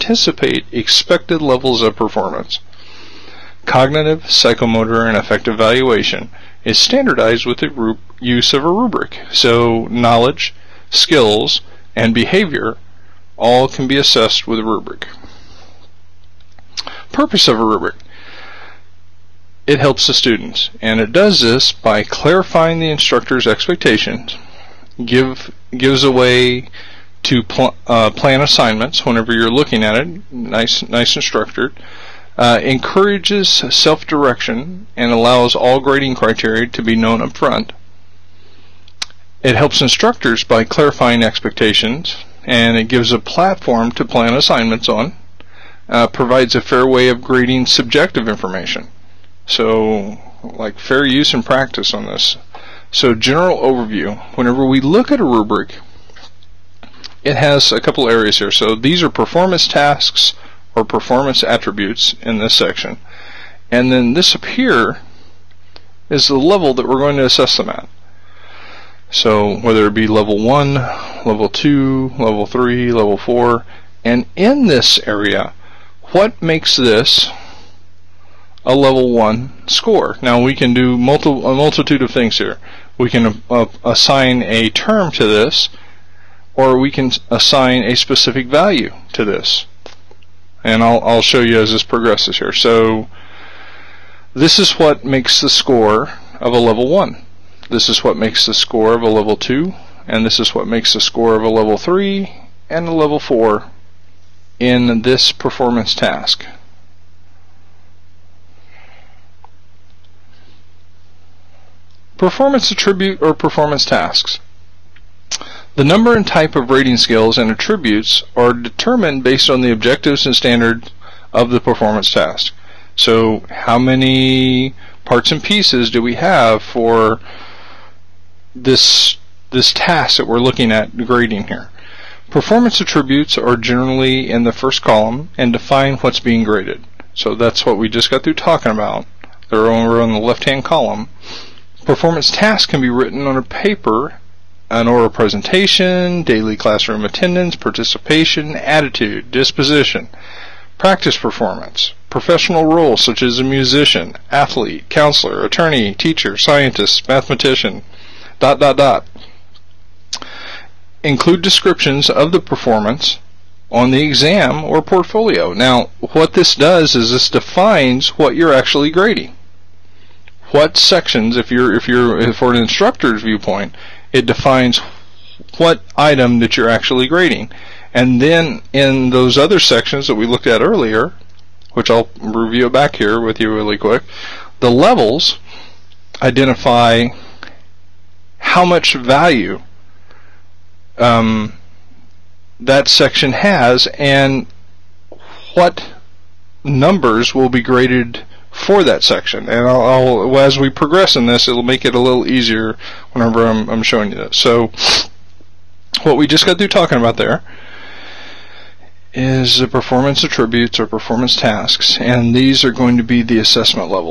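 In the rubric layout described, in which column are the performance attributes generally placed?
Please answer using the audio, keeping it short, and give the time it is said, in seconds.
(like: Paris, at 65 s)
The first column, at 134 s.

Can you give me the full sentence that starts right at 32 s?
Uh, encourages self-direction and allows all grading criteria to be known up front.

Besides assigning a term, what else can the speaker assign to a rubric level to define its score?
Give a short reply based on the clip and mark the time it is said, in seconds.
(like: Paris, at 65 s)
A specific value, at 87 s.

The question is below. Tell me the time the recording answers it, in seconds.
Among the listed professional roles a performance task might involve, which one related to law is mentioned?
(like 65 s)
155 s.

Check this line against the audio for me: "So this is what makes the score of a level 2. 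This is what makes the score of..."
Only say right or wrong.
wrong.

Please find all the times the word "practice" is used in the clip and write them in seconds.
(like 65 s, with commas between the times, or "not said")
51 s, 150 s.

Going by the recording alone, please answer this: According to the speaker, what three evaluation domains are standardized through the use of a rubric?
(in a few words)
Cognitive, psychomotor, and affective.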